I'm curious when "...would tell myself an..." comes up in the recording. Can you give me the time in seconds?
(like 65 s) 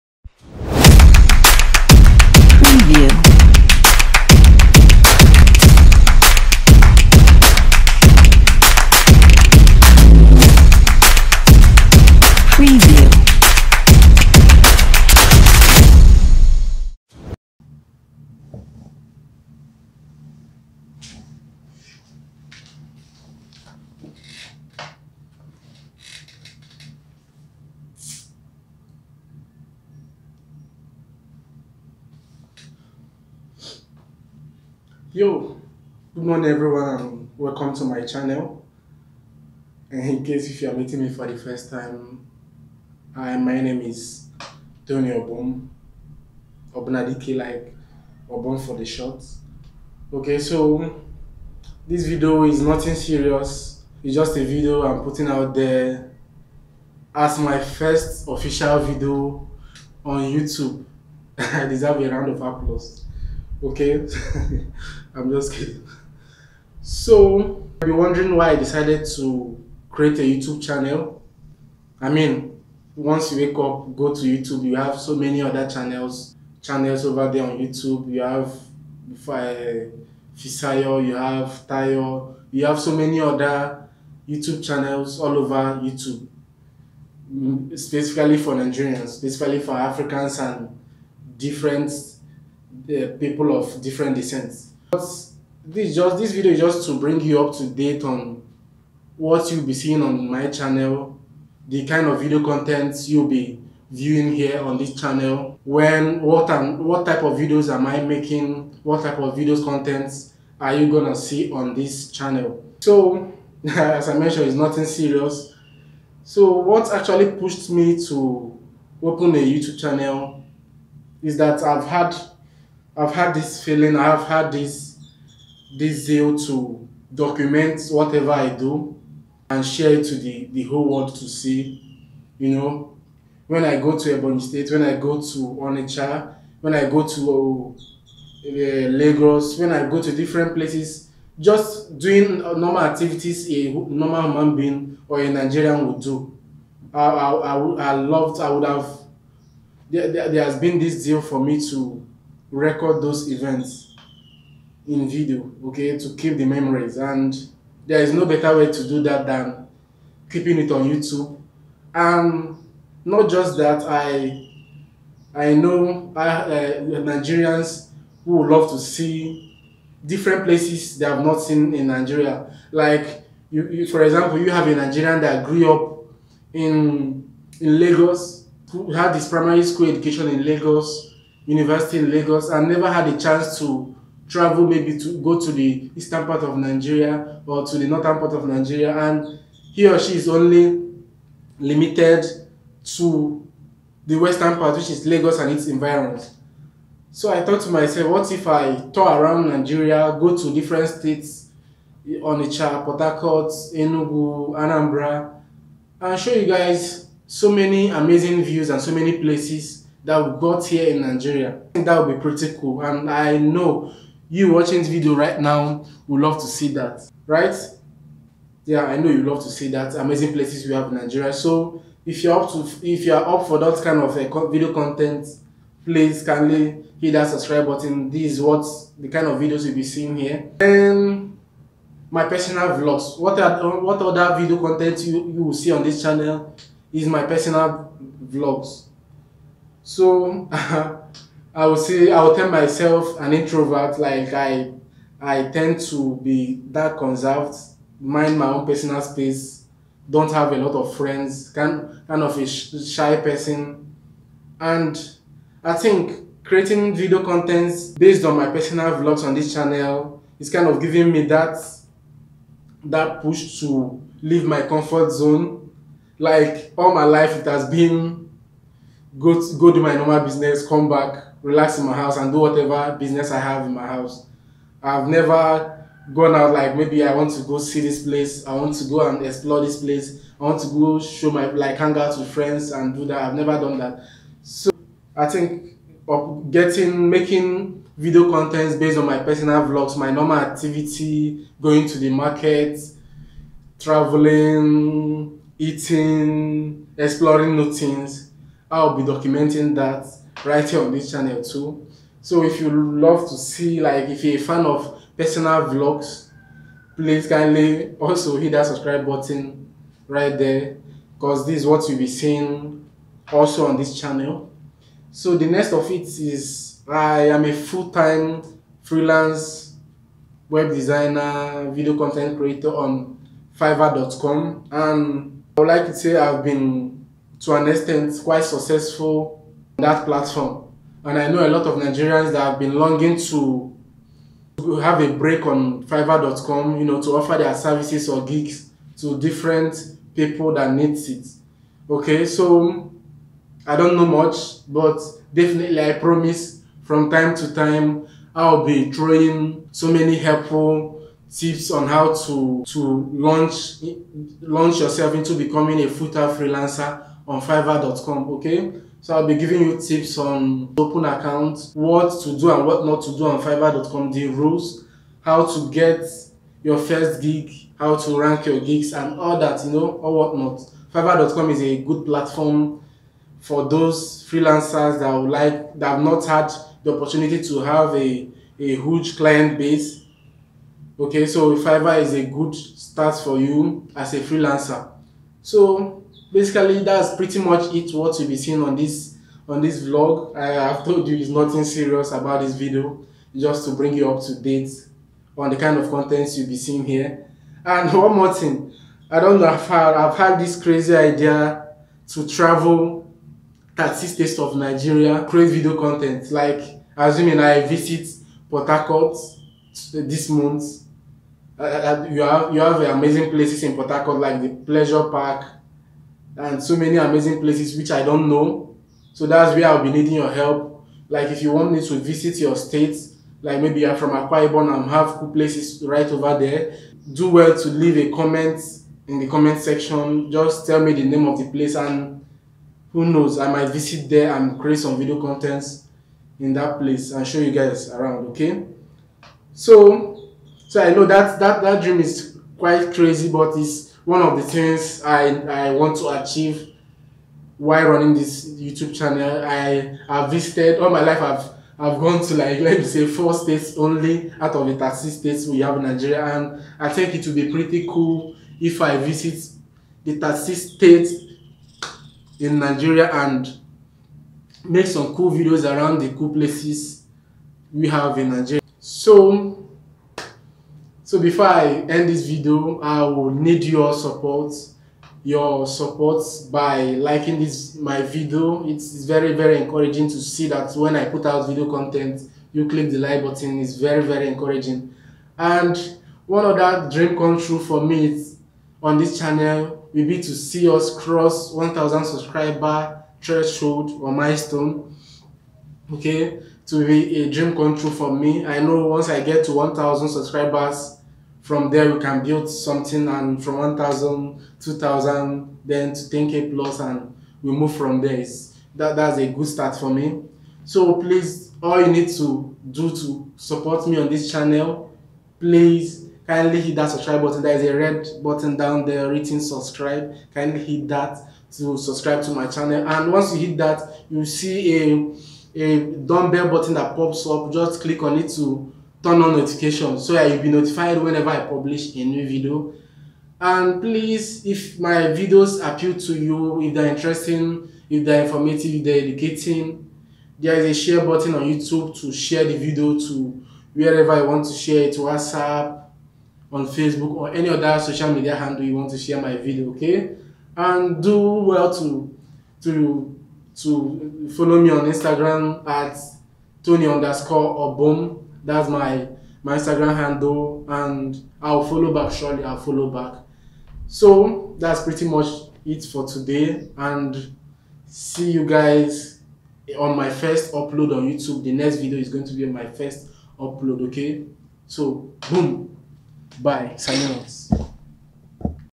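242 s.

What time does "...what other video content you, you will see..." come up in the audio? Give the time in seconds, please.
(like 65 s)
233 s.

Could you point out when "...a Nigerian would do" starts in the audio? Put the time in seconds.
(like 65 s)
145 s.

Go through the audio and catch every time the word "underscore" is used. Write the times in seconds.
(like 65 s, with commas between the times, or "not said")
556 s.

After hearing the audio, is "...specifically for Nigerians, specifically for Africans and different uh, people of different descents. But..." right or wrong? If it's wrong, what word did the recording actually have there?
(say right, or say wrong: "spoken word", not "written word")
right.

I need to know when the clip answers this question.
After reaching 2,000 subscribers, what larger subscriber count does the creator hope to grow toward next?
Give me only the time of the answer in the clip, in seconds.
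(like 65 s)
506 s.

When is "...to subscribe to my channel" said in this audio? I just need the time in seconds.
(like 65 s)
521 s.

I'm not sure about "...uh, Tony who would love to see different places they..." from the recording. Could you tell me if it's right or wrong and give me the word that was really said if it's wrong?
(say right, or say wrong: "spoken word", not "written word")
wrong: "Nigerians", not "Tony".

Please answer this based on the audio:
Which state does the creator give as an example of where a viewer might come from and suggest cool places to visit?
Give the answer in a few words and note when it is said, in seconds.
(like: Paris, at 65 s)
Akwa Ibom, at 424 s.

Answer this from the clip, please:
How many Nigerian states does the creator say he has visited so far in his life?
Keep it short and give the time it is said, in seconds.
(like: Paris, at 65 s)
4, at 453 s.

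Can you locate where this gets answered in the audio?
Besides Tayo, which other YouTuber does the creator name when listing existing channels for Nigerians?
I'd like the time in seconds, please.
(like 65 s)
80 s.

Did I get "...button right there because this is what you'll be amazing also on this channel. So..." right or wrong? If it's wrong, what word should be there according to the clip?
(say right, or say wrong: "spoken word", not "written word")
wrong: "seeing", not "amazing".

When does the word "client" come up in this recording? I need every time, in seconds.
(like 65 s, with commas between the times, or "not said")
379 s.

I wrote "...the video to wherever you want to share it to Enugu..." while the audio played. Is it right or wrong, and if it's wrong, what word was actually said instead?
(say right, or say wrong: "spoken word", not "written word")
wrong: "WhatsApp", not "Enugu".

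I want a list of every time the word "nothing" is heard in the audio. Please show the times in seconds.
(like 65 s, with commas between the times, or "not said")
52 s, 114 s, 391 s.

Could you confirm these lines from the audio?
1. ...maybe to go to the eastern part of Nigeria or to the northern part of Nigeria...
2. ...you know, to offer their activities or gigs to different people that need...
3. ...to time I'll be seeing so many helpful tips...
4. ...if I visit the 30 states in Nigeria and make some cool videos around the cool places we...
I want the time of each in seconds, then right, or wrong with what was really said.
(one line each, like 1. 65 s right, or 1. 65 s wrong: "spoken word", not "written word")
1. 184 s right
2. 336 s wrong: "services", not "activities"
3. 347 s wrong: "throwing", not "seeing"
4. 458 s right.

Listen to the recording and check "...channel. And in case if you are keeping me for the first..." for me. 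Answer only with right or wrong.
wrong.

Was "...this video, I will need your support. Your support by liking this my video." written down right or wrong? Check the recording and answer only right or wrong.
right.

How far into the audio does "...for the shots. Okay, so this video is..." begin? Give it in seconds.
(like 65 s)
48 s.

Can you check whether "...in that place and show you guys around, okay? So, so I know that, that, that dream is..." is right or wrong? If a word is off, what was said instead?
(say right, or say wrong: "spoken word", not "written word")
right.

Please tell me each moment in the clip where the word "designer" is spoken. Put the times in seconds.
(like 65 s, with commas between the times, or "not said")
320 s.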